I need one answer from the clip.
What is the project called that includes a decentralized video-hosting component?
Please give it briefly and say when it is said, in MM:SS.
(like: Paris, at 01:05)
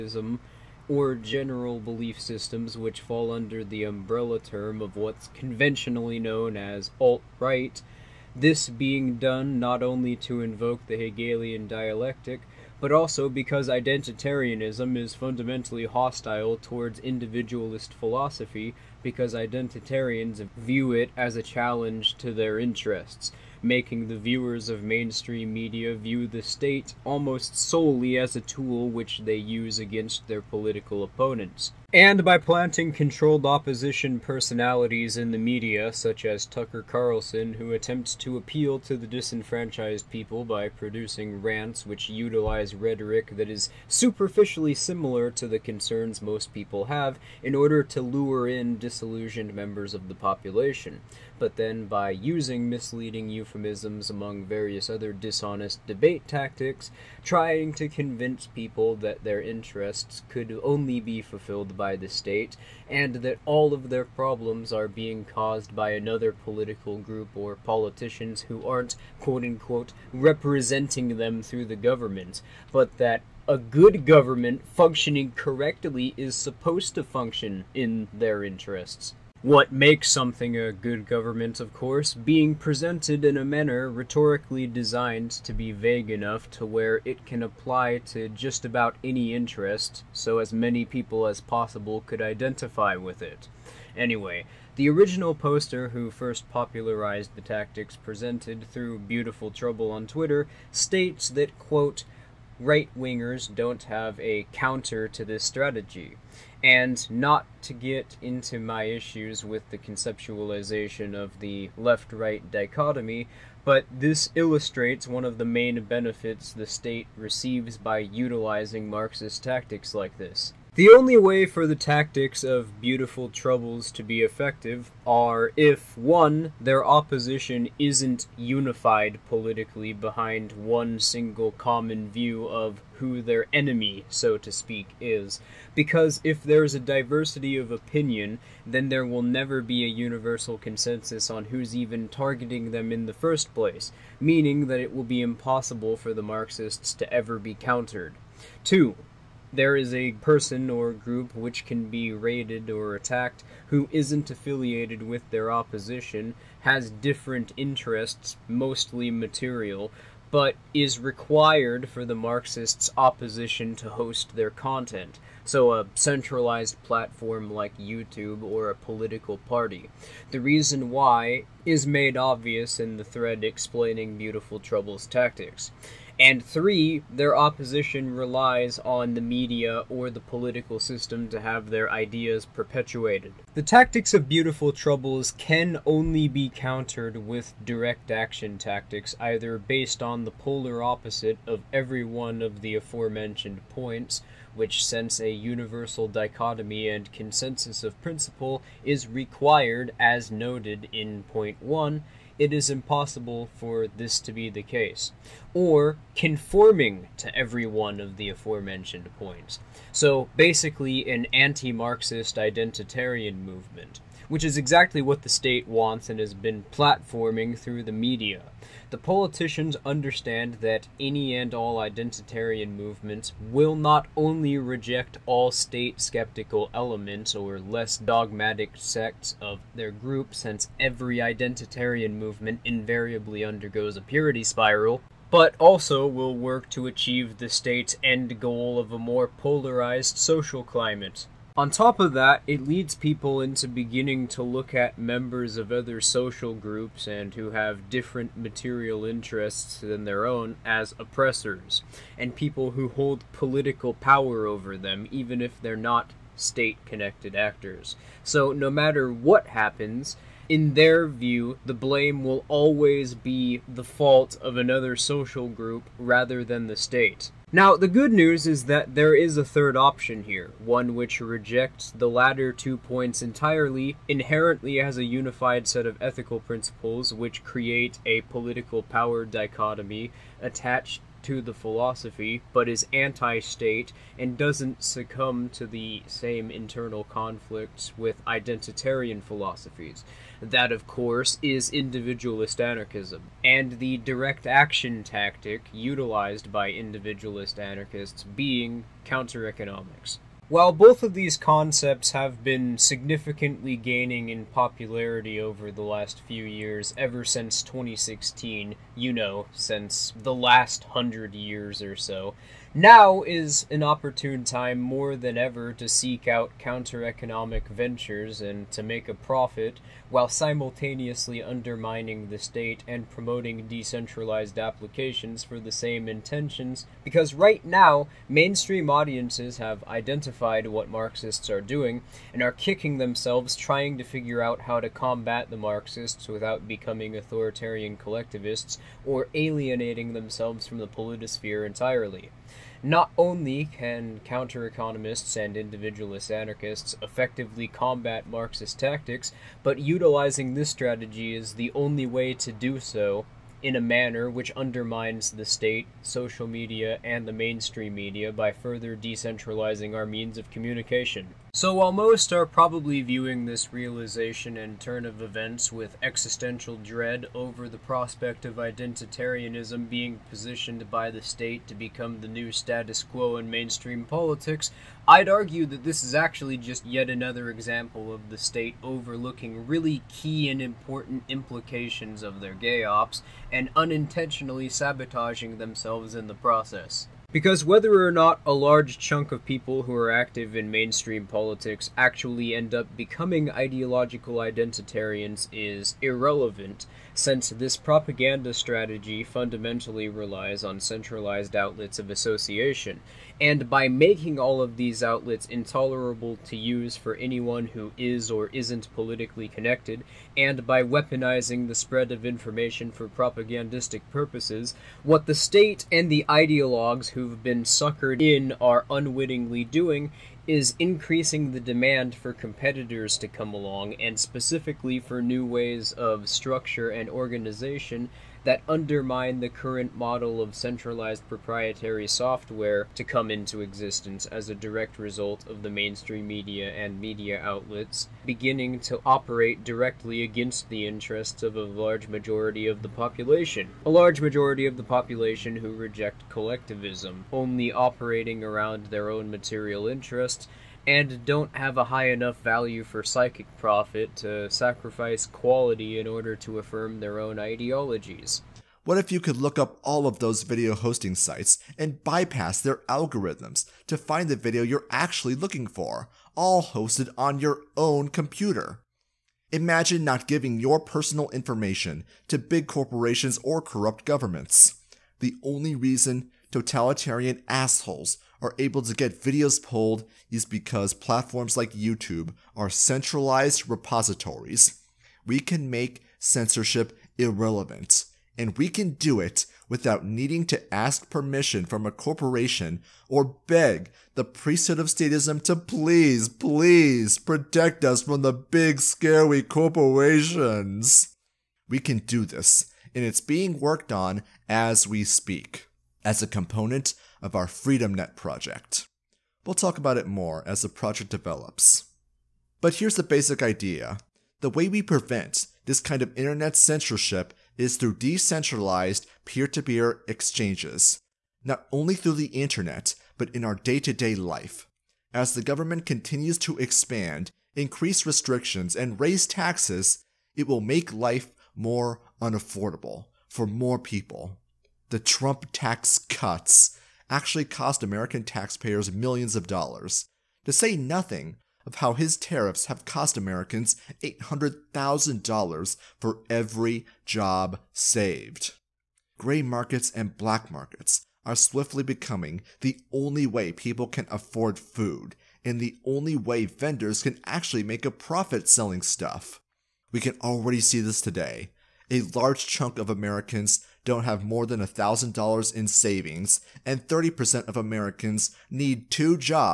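FreedomNet, at 08:27.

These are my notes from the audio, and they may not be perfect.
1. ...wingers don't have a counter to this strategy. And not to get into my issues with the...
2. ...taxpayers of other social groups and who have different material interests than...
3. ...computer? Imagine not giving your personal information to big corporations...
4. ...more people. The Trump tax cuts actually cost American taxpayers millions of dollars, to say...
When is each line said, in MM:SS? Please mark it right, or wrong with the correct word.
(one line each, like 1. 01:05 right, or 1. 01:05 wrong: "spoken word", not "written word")
1. 01:42 right
2. 04:04 wrong: "members", not "taxpayers"
3. 07:48 right
4. 08:53 right.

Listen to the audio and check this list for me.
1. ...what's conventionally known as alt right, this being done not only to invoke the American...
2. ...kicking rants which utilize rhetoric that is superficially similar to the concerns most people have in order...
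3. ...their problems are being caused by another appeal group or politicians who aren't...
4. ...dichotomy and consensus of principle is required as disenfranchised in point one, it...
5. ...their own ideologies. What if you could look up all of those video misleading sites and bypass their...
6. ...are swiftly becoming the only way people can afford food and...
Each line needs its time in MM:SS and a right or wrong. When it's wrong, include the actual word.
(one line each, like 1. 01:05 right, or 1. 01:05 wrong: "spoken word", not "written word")
1. 00:04 wrong: "Hegelian", not "American"
2. 00:40 wrong: "producing", not "kicking"
3. 01:03 wrong: "political", not "appeal"
4. 03:16 wrong: "noted", not "disenfranchised"
5. 07:36 wrong: "hosting", not "misleading"
6. 09:11 right.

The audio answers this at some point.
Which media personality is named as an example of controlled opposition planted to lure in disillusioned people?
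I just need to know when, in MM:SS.
00:36.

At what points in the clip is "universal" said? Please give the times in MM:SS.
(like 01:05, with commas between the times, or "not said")
02:19, 03:15.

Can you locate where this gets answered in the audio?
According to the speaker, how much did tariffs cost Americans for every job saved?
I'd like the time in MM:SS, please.
09:04.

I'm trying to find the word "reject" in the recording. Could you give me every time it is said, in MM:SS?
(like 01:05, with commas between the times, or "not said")
03:44, 04:31, 07:25.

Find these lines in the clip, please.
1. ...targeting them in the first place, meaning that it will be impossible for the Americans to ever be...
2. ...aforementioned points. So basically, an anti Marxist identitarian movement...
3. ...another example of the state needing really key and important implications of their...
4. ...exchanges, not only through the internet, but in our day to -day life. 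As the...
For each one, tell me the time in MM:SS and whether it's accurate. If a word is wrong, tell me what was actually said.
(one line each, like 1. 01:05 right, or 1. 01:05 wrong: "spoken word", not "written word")
1. 02:22 wrong: "Marxists", not "Americans"
2. 03:28 right
3. 06:17 wrong: "overlooking", not "needing"
4. 08:40 right.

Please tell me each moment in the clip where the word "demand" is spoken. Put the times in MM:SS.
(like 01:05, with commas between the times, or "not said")
07:01.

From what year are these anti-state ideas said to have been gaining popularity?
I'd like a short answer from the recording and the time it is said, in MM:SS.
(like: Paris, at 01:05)
2016, at 05:07.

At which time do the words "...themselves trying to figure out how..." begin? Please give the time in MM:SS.
05:32.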